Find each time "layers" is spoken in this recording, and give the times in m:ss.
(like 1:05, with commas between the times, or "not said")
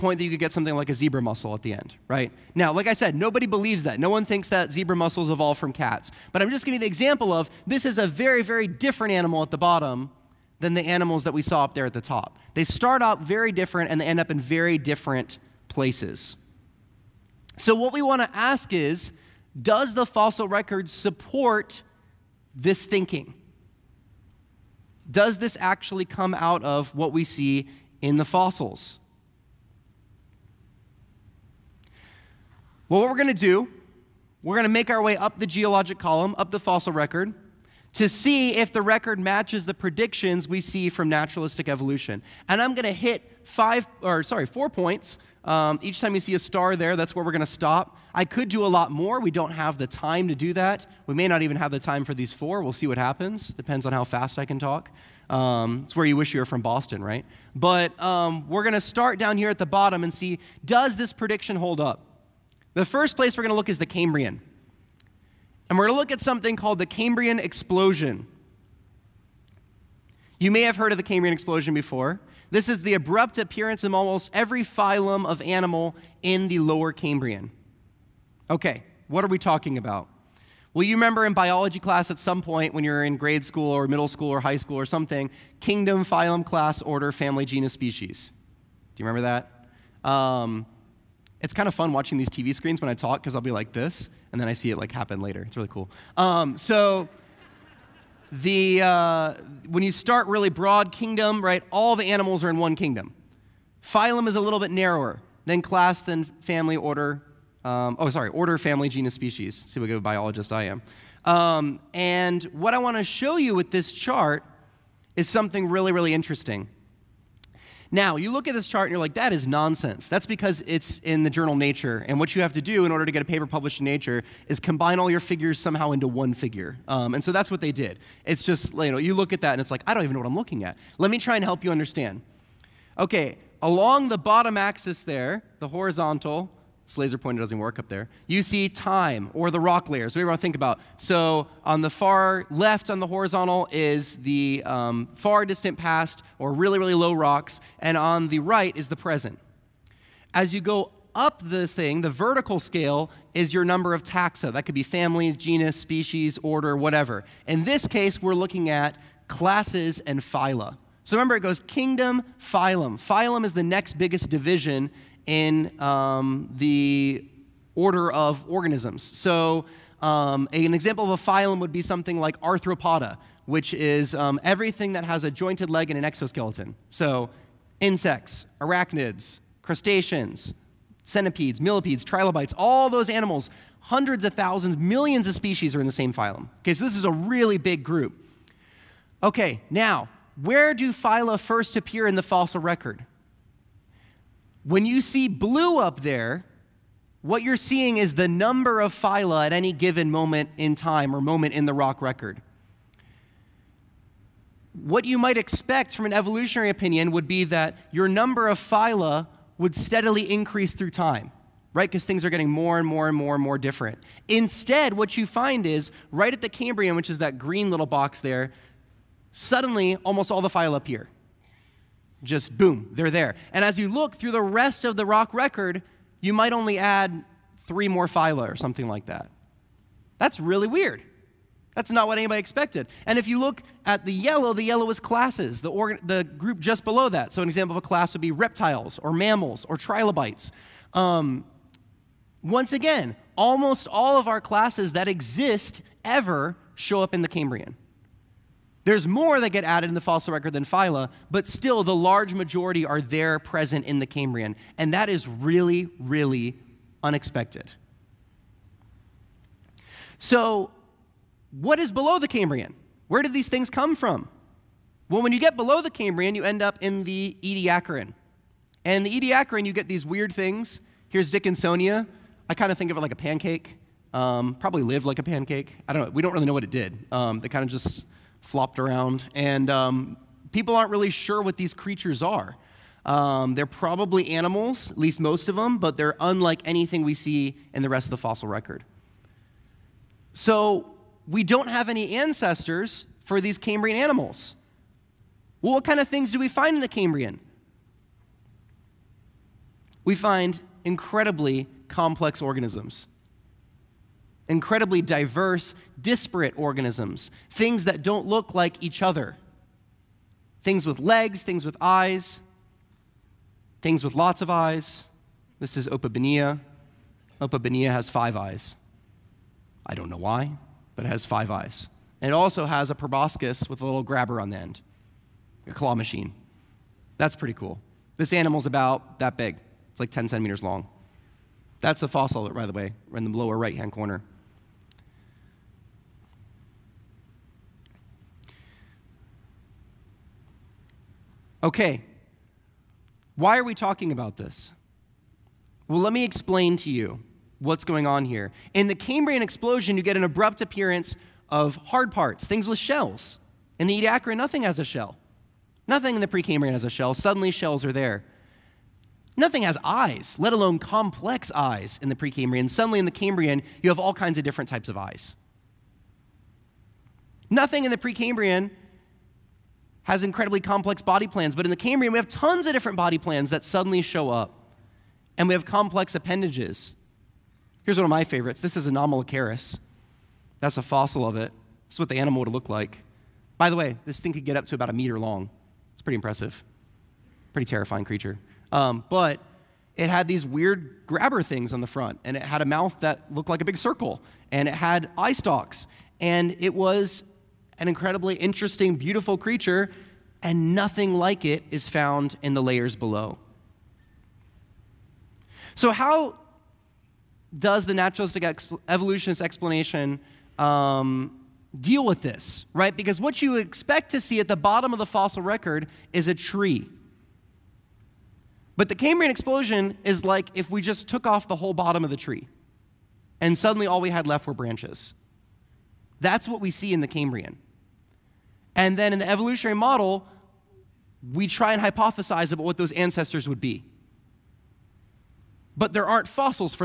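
2:19, 6:42.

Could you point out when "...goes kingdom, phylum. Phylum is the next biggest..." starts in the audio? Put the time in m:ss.
2:41.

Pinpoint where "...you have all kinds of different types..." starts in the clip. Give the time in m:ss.
6:03.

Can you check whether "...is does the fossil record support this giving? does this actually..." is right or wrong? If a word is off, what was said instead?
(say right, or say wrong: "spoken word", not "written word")
wrong: "thinking", not "giving".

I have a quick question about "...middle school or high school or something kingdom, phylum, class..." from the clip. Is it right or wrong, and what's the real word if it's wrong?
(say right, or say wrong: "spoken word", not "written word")
right.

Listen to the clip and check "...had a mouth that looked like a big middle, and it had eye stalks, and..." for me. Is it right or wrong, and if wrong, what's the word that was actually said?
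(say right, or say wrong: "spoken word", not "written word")
wrong: "circle", not "middle".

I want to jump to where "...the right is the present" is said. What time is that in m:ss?
2:28.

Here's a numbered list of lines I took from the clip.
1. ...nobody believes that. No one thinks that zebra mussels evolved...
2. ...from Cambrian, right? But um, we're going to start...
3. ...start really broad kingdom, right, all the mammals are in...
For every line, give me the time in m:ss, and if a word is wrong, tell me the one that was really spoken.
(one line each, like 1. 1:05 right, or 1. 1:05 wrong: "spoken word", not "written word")
1. 0:03 right
2. 0:56 wrong: "Boston", not "Cambrian"
3. 1:39 wrong: "animals", not "mammals".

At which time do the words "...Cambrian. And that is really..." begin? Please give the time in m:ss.
4:14.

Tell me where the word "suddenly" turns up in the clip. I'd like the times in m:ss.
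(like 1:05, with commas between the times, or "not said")
3:39, 5:57, 6:02, 6:13, 7:03.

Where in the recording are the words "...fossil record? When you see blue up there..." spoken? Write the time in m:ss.
3:12.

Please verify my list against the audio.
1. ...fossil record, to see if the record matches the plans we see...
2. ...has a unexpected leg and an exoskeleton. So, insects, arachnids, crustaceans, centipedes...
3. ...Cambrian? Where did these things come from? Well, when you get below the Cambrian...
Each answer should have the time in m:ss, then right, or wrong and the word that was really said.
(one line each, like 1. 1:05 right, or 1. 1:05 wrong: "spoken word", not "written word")
1. 0:36 wrong: "predictions", not "plans"
2. 2:55 wrong: "jointed", not "unexpected"
3. 4:22 right.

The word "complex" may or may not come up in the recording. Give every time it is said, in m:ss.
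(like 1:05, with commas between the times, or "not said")
5:01, 6:00, 6:10, 6:15.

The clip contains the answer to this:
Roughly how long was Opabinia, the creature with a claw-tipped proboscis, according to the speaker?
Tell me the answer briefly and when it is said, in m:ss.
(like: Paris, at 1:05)
10 centimeters, at 5:30.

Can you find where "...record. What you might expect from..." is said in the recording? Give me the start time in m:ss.
3:22.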